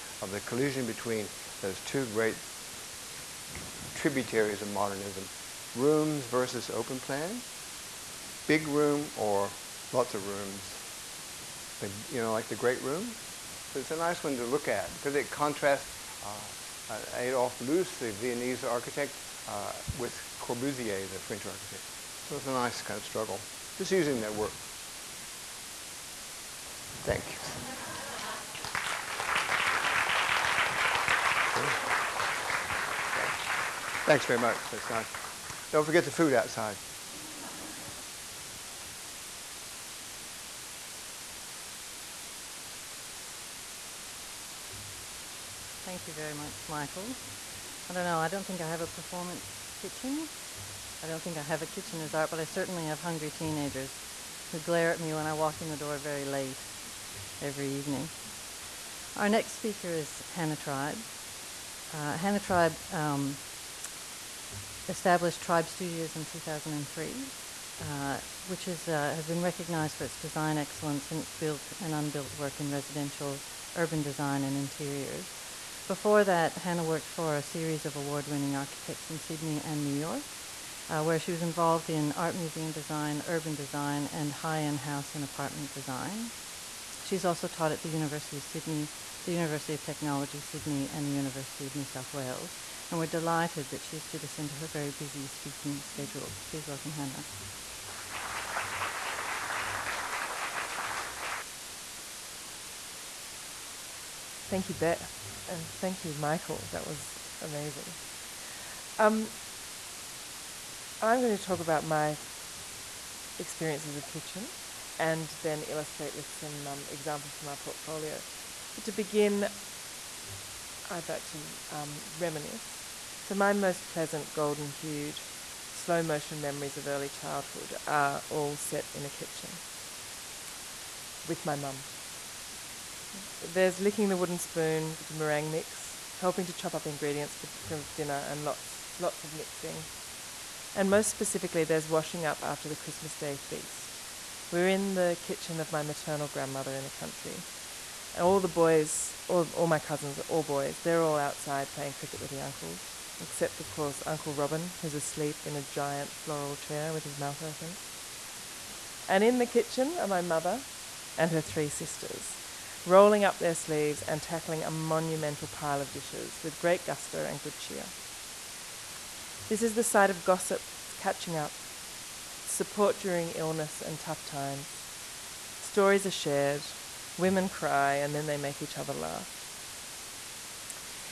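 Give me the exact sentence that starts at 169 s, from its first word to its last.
This is the side of gossip, catching up, support during illness and tough times.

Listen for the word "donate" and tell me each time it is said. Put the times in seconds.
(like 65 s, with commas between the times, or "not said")
not said.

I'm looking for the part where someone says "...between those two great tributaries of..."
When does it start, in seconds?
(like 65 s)
0 s.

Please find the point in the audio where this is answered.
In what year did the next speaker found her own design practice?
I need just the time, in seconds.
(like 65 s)
66 s.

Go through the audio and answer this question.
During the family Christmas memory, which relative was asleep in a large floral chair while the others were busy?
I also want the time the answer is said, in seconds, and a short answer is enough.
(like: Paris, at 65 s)
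Uncle Robin, at 154 s.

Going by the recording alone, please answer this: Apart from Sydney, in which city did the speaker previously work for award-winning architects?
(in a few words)
New York.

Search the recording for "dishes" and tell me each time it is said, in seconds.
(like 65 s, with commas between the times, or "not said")
165 s.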